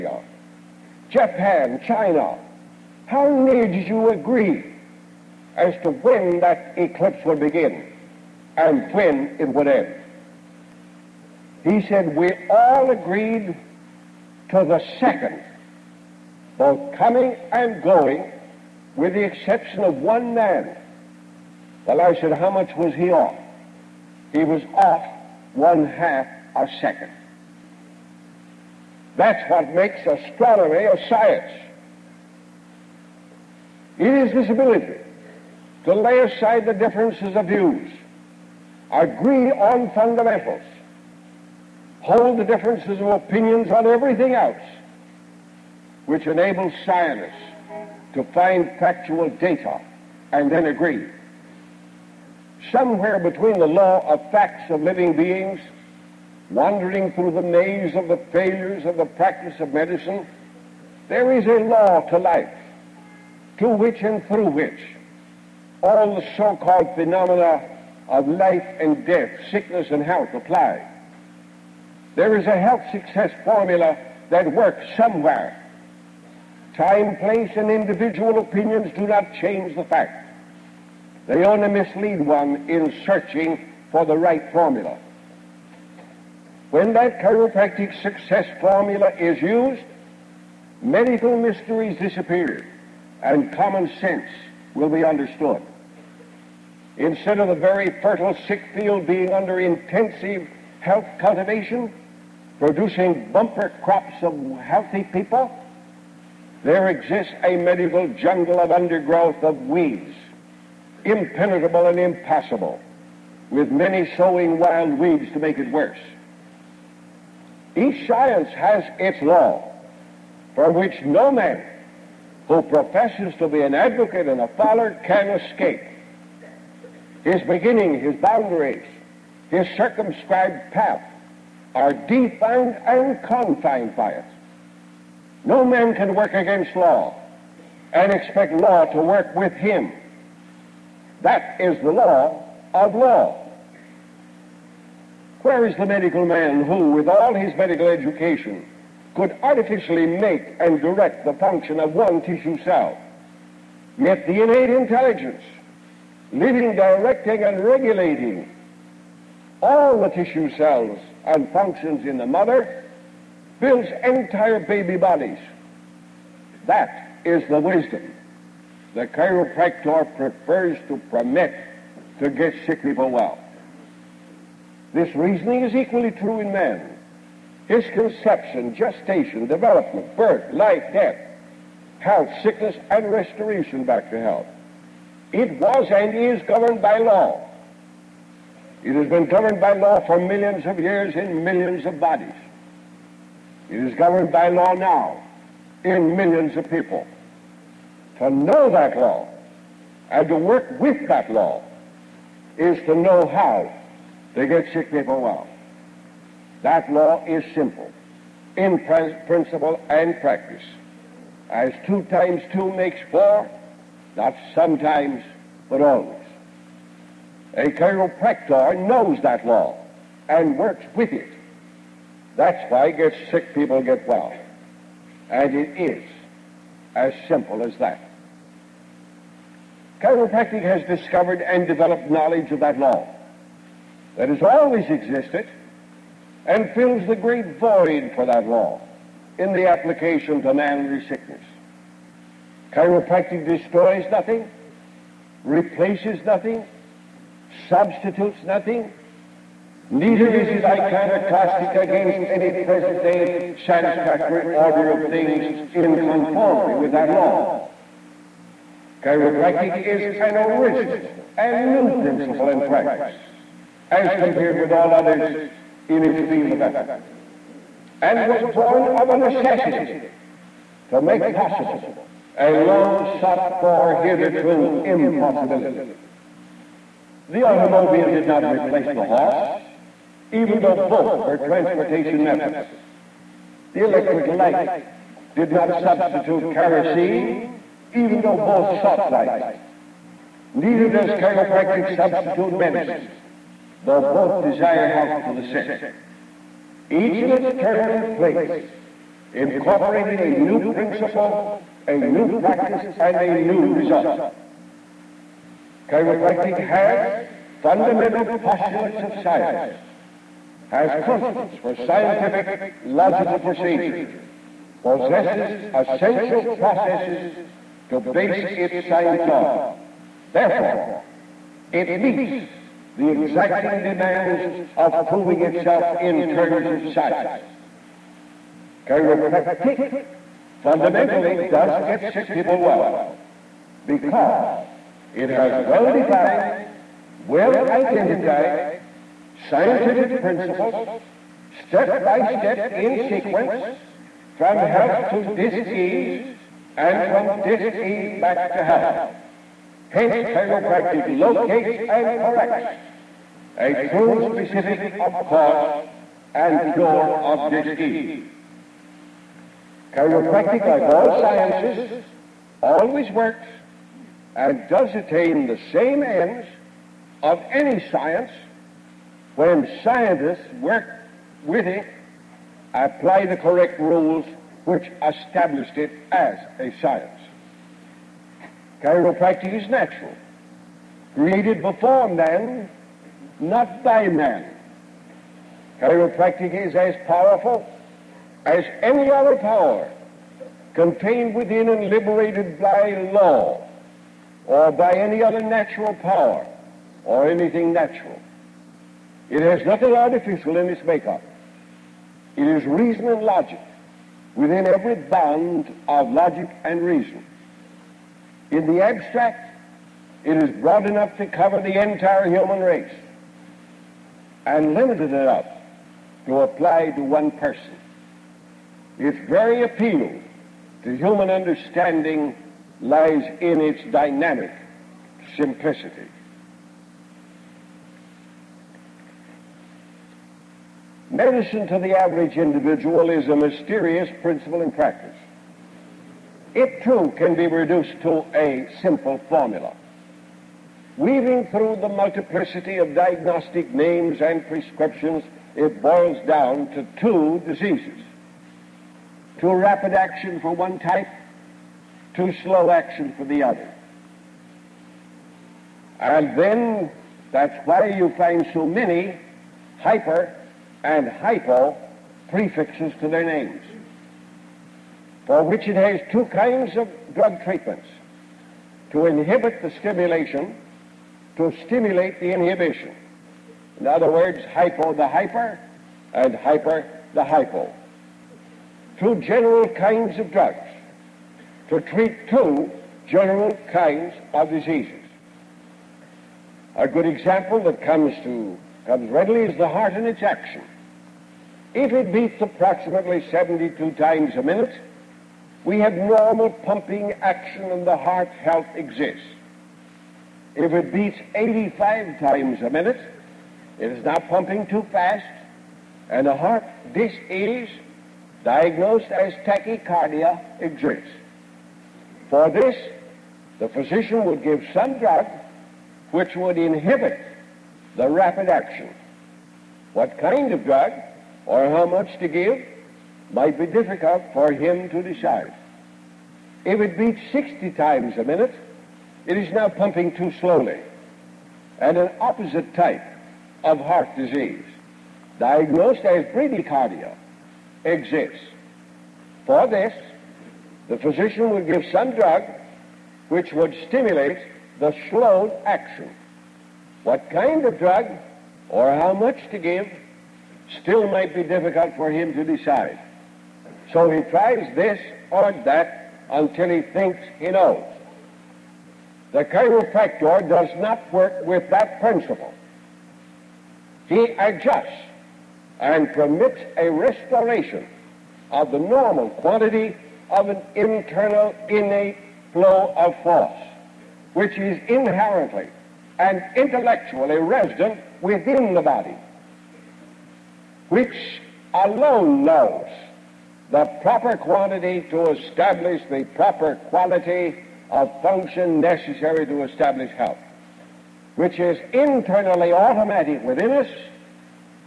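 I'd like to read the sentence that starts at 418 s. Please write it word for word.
Its very appeal to human understanding lies in its dynamic simplicity.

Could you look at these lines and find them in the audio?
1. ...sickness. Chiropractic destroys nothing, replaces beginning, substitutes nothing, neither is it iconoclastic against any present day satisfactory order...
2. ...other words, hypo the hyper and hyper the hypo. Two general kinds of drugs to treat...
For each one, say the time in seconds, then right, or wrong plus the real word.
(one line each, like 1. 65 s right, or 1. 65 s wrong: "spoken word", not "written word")
1. 241 s wrong: "nothing", not "beginning"
2. 473 s right.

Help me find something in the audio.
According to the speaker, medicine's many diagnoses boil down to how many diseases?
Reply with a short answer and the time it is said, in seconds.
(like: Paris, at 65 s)
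2, at 446 s.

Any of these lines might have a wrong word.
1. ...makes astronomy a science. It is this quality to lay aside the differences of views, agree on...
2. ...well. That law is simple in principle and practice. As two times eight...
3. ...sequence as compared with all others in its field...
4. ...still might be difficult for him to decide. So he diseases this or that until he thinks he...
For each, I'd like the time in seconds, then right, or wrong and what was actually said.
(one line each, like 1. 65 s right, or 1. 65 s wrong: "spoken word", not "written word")
1. 29 s wrong: "ability", not "quality"
2. 205 s wrong: "two", not "eight"
3. 262 s wrong: "practice", not "sequence"
4. 550 s wrong: "tries", not "diseases".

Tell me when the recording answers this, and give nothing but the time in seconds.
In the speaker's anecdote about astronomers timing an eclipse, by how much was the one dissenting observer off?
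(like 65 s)
25 s.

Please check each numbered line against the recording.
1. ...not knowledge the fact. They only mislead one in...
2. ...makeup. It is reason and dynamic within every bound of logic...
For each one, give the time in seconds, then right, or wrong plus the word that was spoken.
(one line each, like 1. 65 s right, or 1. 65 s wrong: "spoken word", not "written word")
1. 79 s wrong: "change", not "knowledge"
2. 400 s wrong: "logic", not "dynamic".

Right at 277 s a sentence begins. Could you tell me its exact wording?
The automobile did not replace the horse, even though both were transportation methods.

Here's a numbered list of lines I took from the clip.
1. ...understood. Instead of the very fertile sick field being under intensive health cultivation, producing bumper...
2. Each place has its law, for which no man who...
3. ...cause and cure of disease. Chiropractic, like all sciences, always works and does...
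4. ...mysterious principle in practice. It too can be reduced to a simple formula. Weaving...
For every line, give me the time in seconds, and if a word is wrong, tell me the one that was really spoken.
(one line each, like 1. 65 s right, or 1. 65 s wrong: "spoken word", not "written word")
1. 95 s right
2. 117 s wrong: "science", not "place"
3. 355 s right
4. 433 s right.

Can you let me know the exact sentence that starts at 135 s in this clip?
No man can work against law and expect law to work with him.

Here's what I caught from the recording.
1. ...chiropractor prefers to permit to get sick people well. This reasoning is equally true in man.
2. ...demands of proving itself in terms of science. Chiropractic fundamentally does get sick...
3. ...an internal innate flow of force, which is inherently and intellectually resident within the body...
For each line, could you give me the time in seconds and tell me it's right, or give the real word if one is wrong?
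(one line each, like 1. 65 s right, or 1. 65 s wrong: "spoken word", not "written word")
1. 169 s right
2. 323 s right
3. 570 s right.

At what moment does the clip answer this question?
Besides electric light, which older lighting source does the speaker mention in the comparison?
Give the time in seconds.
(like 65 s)
286 s.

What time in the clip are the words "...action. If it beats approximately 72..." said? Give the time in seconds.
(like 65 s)
490 s.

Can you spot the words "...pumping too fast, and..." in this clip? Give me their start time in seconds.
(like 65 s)
504 s.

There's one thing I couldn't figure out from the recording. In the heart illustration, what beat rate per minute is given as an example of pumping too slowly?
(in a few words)
60.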